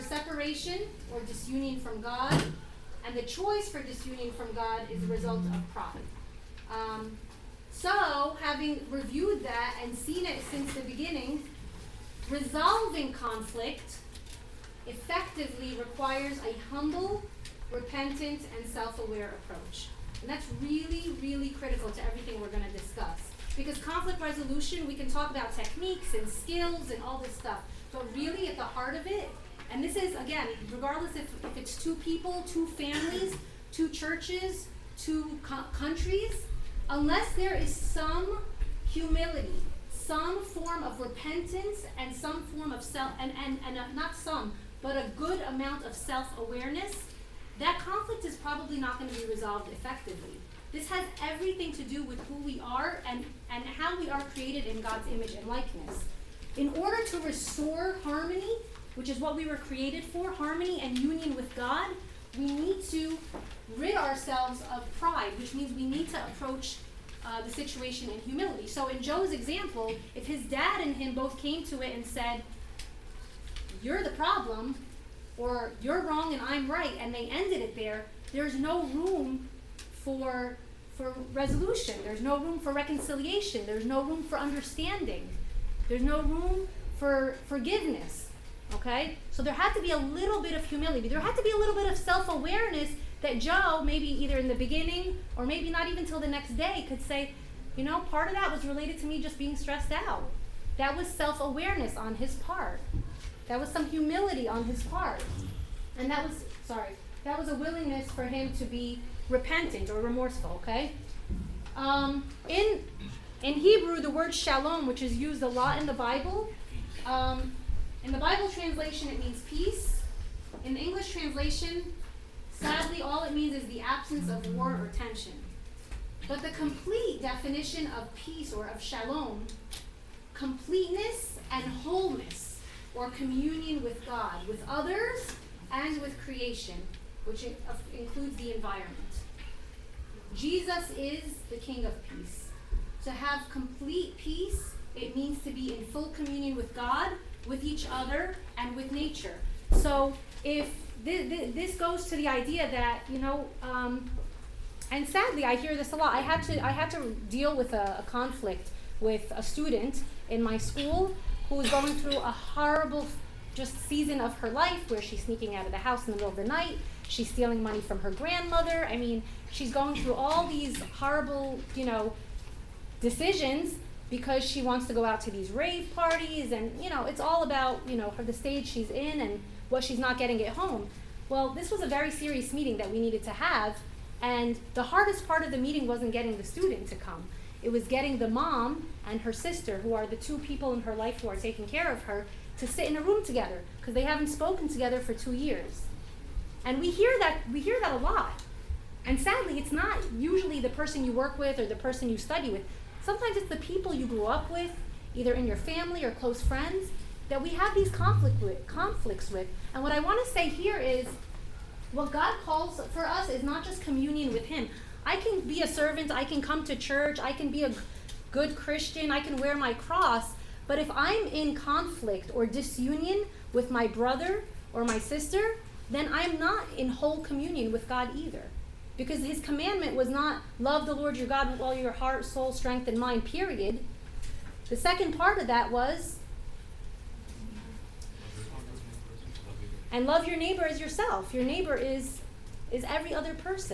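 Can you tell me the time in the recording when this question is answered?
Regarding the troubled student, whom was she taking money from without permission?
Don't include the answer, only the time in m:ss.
2:47.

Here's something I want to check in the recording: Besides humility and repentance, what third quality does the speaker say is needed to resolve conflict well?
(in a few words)
self aware.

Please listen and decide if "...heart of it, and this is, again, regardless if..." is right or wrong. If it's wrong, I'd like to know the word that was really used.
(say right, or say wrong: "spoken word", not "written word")
right.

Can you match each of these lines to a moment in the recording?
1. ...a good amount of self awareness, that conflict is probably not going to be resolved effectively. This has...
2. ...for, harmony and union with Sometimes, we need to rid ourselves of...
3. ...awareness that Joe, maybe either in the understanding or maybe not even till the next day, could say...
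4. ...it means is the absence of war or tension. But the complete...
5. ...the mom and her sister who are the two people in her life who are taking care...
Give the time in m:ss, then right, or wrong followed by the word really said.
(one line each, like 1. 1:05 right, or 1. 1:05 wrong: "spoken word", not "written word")
1. 0:44 right
2. 1:00 wrong: "God", not "Sometimes"
3. 1:32 wrong: "beginning", not "understanding"
4. 2:03 right
5. 3:08 right.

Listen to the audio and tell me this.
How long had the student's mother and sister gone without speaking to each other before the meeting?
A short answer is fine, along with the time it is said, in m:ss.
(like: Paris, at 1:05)
2 years, at 3:15.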